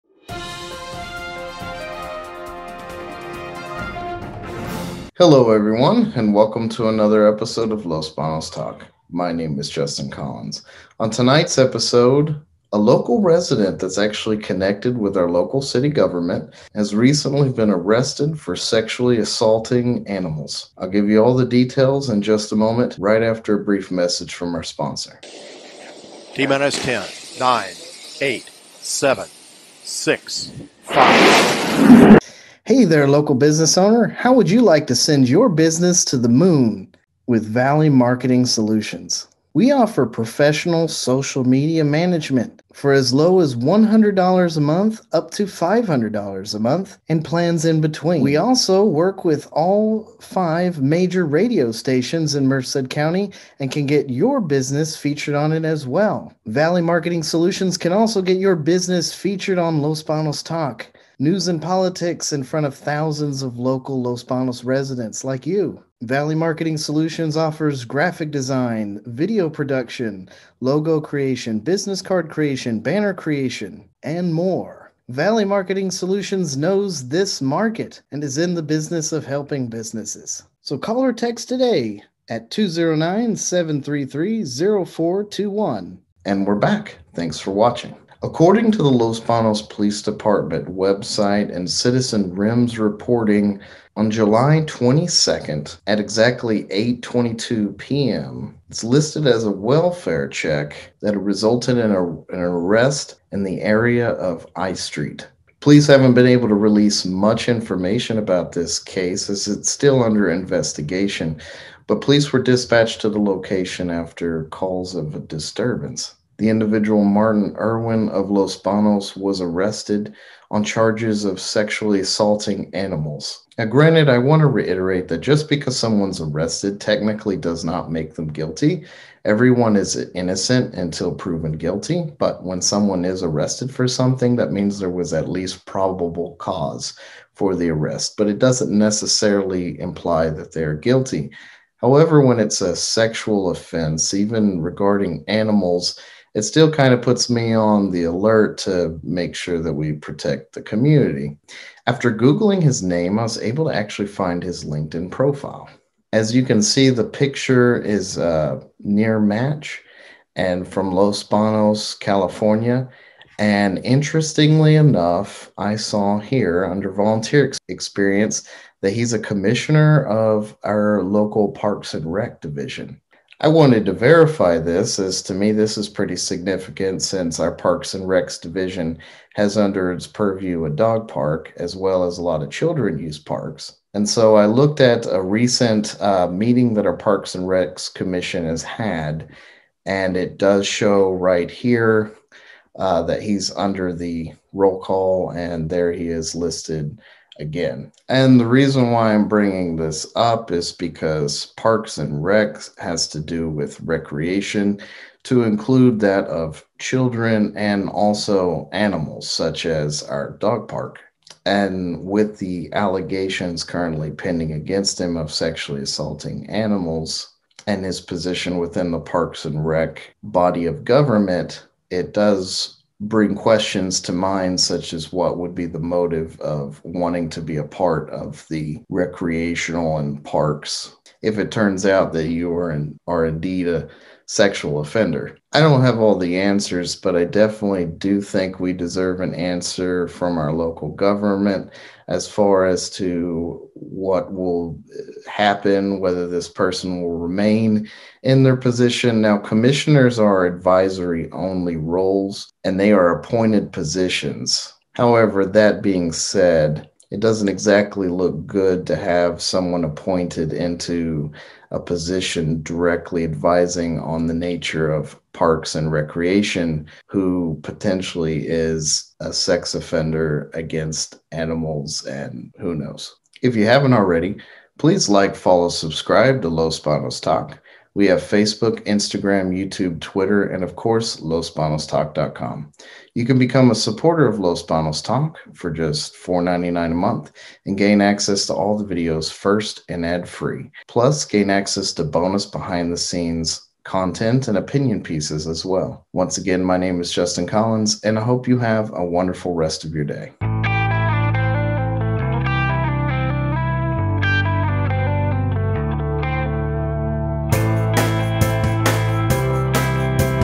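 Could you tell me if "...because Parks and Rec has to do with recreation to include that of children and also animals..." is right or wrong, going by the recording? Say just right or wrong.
right.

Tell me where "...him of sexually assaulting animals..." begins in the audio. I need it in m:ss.
3:34.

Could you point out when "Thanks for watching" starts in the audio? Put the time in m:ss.
1:27.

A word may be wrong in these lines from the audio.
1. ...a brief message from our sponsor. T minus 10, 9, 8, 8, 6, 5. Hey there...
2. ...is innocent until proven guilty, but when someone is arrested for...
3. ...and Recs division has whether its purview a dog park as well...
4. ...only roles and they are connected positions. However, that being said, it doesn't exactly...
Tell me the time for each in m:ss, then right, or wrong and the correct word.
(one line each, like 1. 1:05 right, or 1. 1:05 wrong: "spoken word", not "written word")
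1. 0:23 wrong: "7", not "8"
2. 2:09 right
3. 2:57 wrong: "under", not "whether"
4. 4:11 wrong: "appointed", not "connected".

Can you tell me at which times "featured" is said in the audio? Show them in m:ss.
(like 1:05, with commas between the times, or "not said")
0:54, 0:59.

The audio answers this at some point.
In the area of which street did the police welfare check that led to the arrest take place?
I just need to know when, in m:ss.
1:44.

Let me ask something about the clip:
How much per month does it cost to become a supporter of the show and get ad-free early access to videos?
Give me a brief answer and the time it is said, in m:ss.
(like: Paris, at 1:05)
$4.99, at 4:46.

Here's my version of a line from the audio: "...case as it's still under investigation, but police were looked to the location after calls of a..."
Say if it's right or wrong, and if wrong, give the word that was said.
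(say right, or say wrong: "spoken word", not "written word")
wrong: "dispatched", not "looked".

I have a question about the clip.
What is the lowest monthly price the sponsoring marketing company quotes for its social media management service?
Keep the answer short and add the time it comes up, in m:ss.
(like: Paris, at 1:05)
$100, at 0:43.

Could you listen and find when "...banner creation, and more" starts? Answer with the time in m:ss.
1:12.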